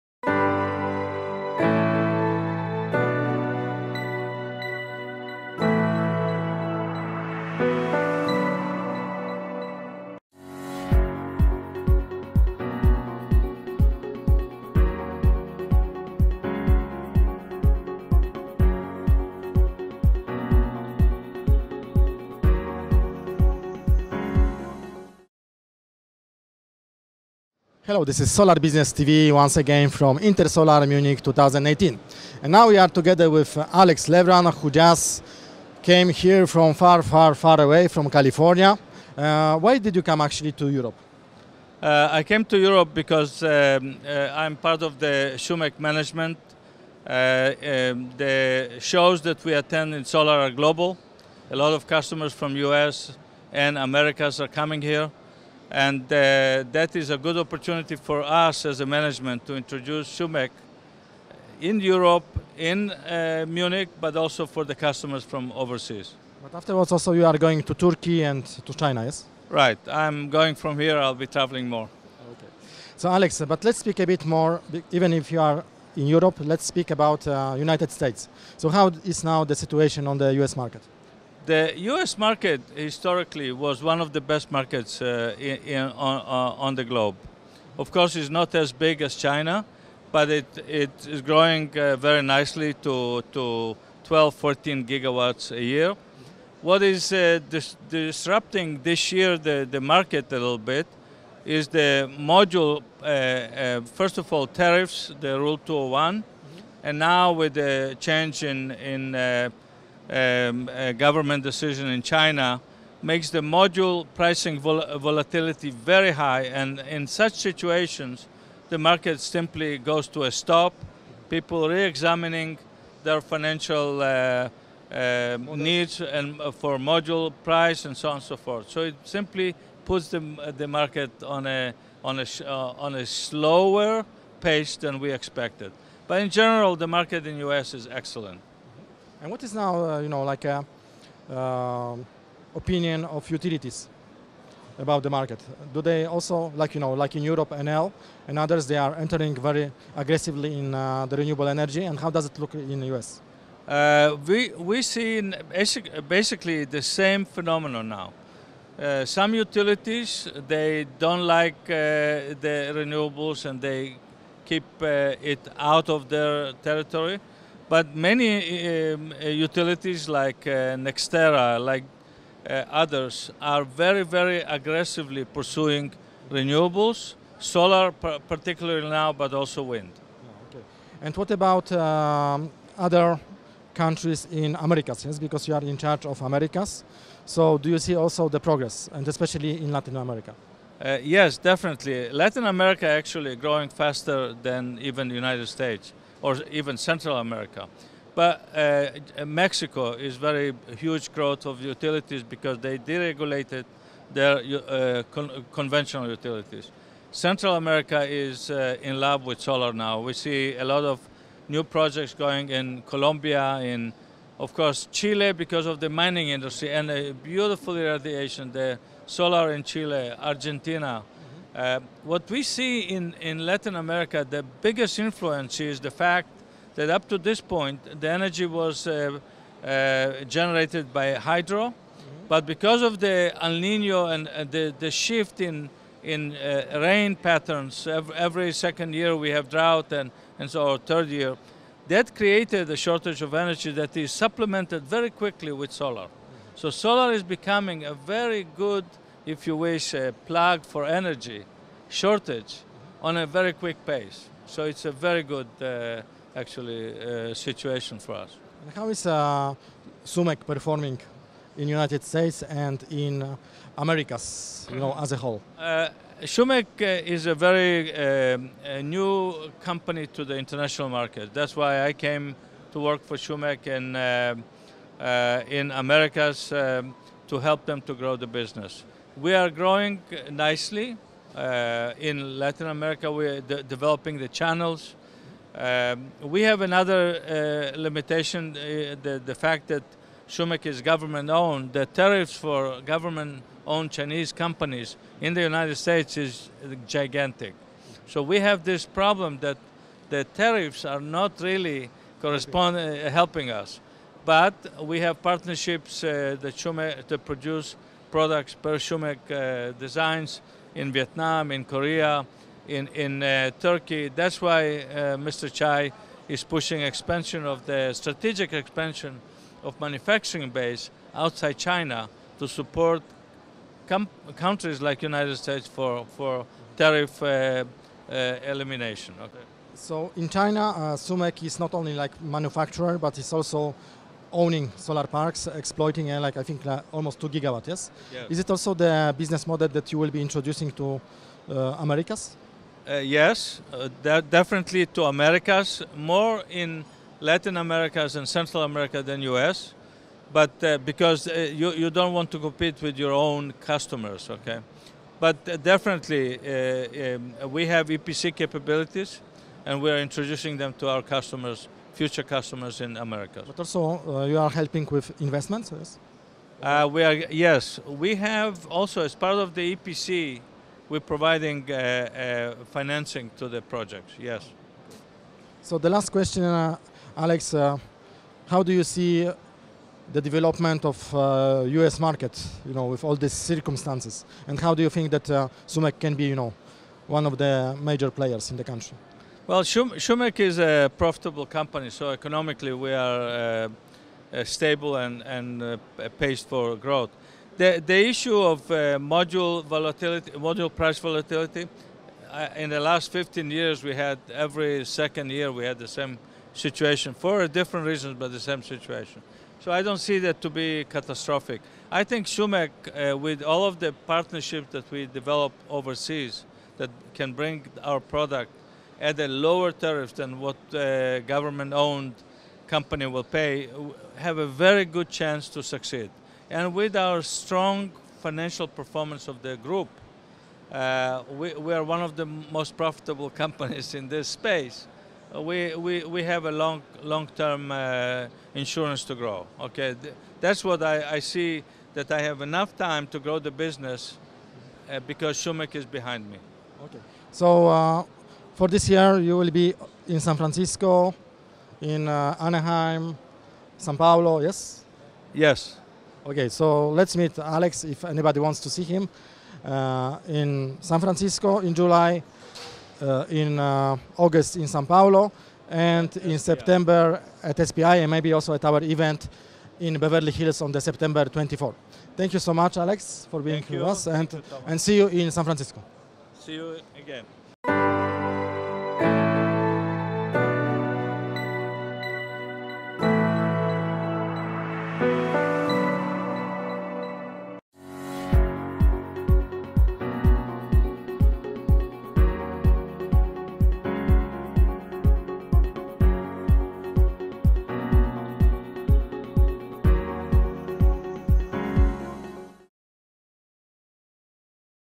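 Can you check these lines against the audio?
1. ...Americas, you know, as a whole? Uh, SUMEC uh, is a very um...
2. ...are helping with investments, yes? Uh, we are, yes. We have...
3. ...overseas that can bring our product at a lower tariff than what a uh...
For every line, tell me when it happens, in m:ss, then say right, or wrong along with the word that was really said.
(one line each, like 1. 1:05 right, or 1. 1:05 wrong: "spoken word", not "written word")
1. 4:23 right
2. 6:04 right
3. 6:55 right.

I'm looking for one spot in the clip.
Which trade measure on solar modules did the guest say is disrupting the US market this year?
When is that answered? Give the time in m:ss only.
1:45.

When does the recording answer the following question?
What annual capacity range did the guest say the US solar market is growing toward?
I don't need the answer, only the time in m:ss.
1:34.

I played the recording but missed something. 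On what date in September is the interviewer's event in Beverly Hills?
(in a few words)
September 24.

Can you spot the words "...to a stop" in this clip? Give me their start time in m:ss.
2:00.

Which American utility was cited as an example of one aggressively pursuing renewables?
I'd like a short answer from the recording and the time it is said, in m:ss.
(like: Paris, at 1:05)
NextEra, at 2:50.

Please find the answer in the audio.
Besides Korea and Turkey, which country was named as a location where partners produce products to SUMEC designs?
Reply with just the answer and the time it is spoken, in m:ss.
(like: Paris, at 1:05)
Vietnam, at 5:10.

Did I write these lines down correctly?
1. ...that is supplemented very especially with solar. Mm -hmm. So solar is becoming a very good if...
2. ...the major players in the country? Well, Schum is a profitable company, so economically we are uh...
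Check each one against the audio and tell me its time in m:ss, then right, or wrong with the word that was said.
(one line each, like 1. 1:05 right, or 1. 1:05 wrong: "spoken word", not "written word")
1. 4:03 wrong: "quickly", not "especially"
2. 6:27 right.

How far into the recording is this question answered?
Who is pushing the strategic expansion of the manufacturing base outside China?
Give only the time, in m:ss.
5:15.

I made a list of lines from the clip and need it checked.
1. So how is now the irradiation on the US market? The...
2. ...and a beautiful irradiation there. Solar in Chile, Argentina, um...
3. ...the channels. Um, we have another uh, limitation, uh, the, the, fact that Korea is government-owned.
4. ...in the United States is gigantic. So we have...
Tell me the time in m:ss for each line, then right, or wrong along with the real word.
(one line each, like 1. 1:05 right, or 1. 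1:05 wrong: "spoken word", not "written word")
1. 1:18 wrong: "situation", not "irradiation"
2. 3:36 right
3. 4:44 wrong: "SUMEC", not "Korea"
4. 4:55 right.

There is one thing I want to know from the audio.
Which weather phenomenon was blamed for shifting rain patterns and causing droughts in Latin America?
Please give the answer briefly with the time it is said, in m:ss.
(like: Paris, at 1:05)
El Nino, at 3:53.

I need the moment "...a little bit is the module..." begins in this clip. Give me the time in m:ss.
1:40.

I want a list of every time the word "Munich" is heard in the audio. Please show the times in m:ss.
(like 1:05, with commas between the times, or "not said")
0:30, 1:03.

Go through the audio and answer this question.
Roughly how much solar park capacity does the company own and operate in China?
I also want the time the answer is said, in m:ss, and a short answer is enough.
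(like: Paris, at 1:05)
2 gigawatts, at 5:37.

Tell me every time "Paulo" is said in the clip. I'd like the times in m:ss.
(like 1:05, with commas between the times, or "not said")
7:33, 7:44.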